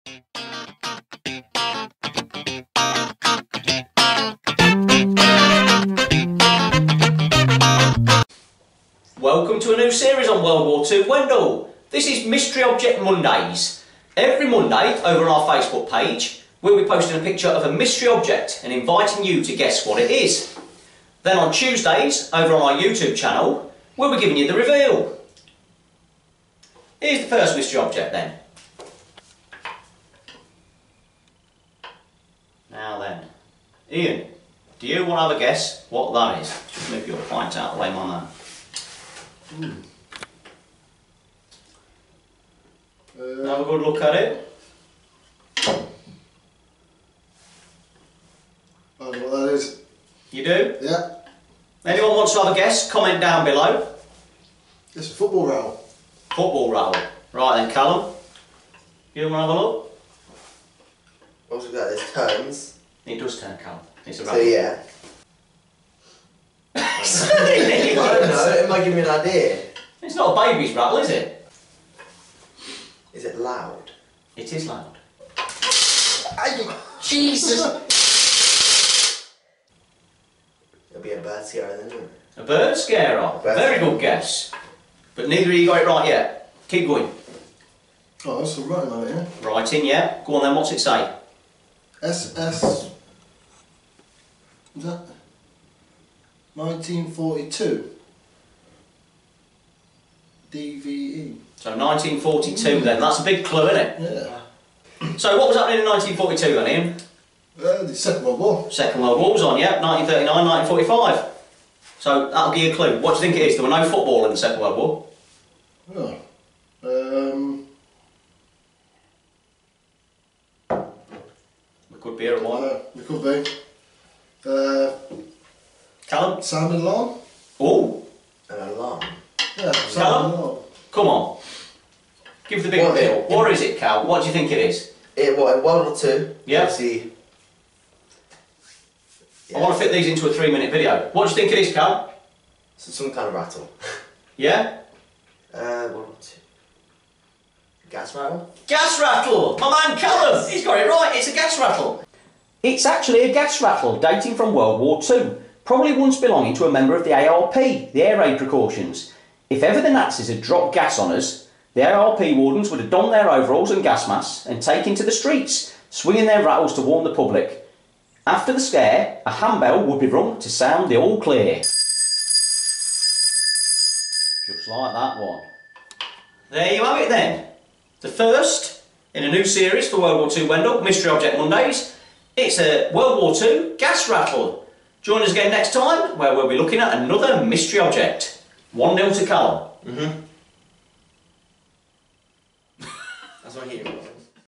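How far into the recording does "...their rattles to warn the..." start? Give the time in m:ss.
2:46.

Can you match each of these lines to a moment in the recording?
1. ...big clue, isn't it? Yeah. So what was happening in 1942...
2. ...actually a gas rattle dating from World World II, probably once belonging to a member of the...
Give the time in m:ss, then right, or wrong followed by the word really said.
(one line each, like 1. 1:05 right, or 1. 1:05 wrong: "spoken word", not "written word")
1. 1:43 right
2. 2:32 wrong: "War", not "World".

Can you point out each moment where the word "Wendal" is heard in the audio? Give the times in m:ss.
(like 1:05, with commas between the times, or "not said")
0:11, 3:00.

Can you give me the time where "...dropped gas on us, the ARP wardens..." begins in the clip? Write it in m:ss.
2:40.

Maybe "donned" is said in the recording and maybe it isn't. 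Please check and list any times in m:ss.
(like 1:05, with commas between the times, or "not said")
2:42.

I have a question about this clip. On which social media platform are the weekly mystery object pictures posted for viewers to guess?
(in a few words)
Facebook.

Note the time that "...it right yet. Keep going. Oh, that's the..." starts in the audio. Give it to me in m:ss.
1:25.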